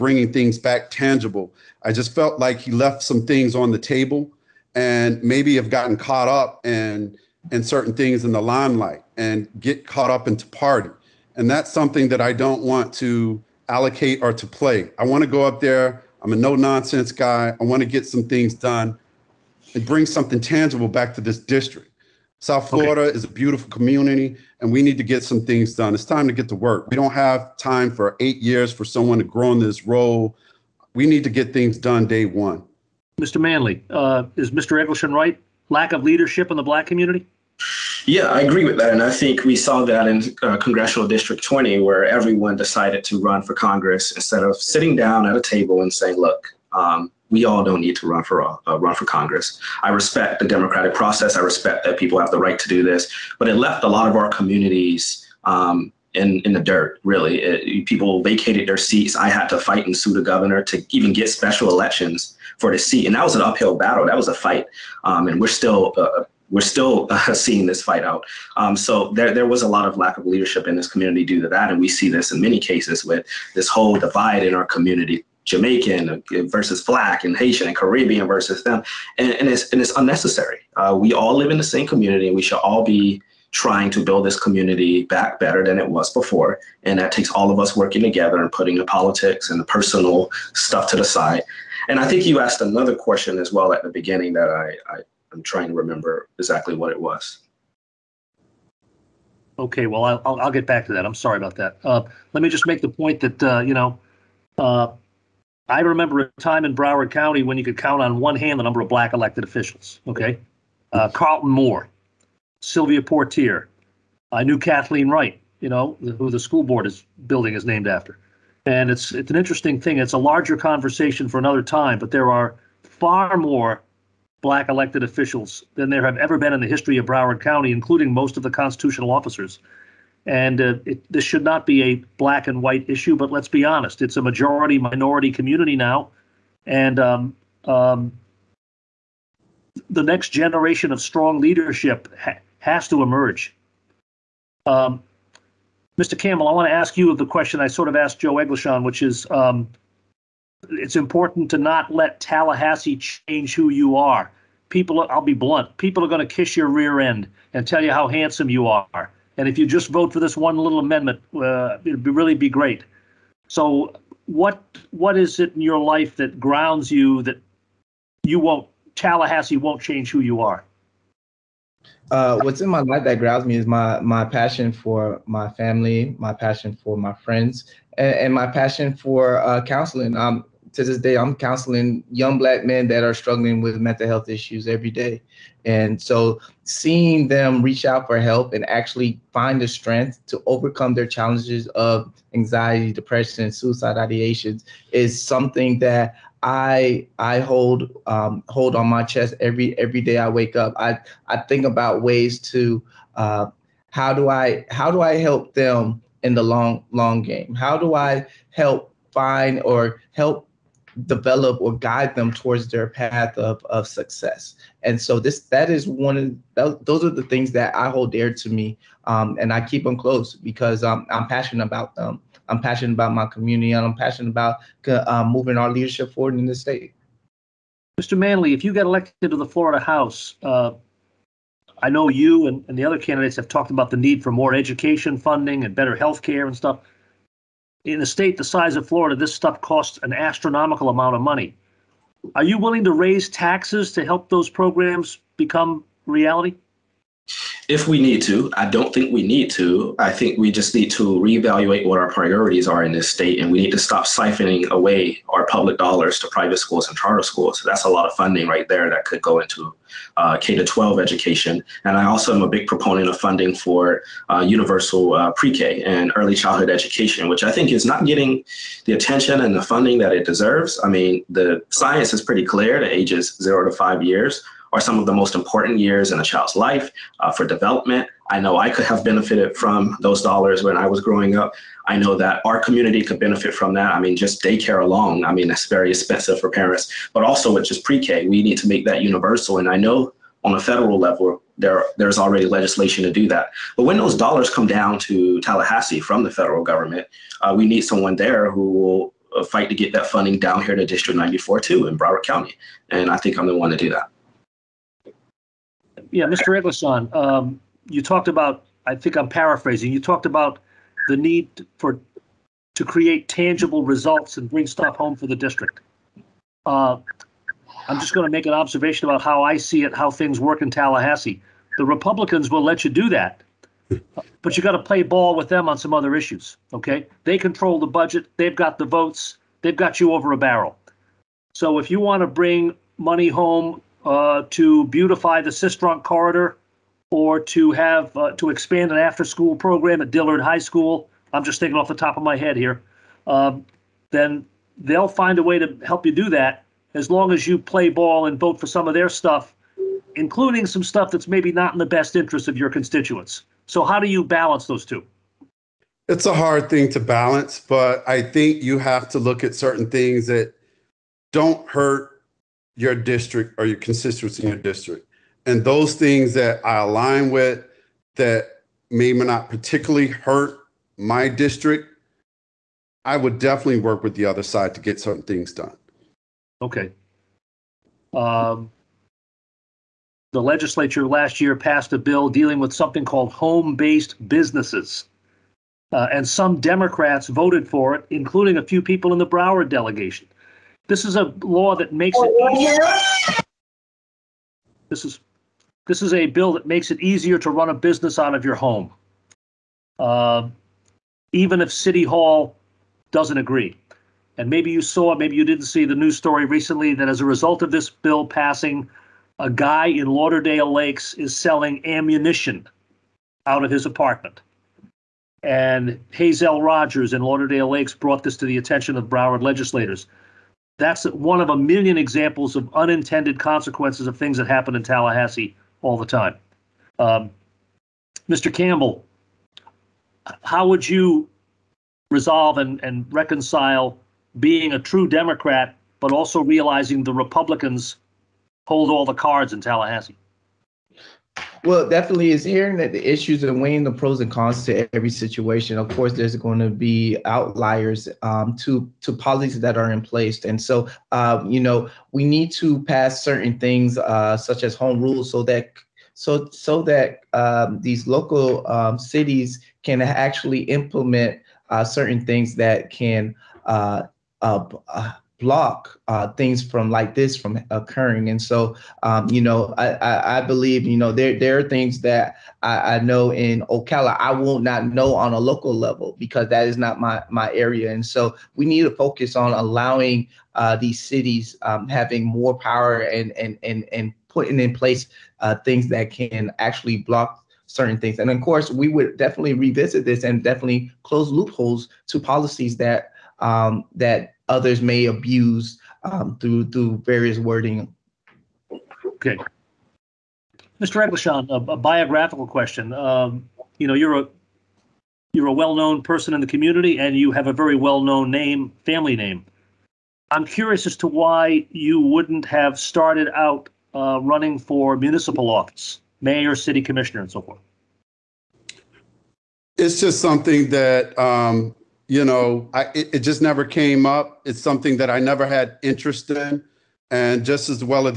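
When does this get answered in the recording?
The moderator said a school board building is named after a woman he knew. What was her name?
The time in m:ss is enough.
1:54.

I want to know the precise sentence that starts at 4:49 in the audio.
And I know on a federal level, there, there's already legislation to do that.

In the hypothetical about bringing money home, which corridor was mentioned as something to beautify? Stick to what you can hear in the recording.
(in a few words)
Sistrunk corridor.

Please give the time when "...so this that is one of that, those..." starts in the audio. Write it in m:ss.
3:35.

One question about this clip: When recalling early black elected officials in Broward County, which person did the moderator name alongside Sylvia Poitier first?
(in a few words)
Carlton Moore.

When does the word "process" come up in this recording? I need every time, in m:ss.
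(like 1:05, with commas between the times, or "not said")
0:50.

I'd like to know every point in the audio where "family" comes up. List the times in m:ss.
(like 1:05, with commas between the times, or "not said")
2:55, 8:28.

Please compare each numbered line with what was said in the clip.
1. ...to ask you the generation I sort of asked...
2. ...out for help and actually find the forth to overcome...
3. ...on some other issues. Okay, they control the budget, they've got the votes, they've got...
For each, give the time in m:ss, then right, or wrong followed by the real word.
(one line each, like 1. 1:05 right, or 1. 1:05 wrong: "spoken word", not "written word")
1. 2:26 wrong: "question", not "generation"
2. 3:07 wrong: "strength", not "forth"
3. 5:25 right.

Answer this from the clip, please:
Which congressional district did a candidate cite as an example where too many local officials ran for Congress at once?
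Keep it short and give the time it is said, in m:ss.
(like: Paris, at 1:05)
Congressional District 20, at 0:40.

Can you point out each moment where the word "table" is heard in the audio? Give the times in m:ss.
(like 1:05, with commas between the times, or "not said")
0:03, 0:45.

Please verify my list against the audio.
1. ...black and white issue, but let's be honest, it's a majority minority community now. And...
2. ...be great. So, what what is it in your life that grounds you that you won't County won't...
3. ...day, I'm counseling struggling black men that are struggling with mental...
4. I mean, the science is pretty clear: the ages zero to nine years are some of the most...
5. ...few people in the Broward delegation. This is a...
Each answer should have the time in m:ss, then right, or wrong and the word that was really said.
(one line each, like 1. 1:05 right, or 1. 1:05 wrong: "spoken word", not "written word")
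1. 2:12 right
2. 2:42 wrong: "Tallahassee", not "County"
3. 3:00 wrong: "young", not "struggling"
4. 4:30 wrong: "five", not "nine"
5. 6:28 right.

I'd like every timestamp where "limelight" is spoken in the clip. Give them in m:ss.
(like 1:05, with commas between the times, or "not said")
0:08.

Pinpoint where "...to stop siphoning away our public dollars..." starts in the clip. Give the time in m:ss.
4:13.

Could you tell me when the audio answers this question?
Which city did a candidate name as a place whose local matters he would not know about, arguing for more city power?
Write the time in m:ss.
7:53.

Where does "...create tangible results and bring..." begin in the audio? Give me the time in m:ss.
5:12.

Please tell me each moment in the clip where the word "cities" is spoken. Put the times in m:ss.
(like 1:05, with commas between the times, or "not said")
7:38, 8:01.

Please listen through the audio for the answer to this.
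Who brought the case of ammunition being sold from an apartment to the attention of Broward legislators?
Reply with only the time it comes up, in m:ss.
6:56.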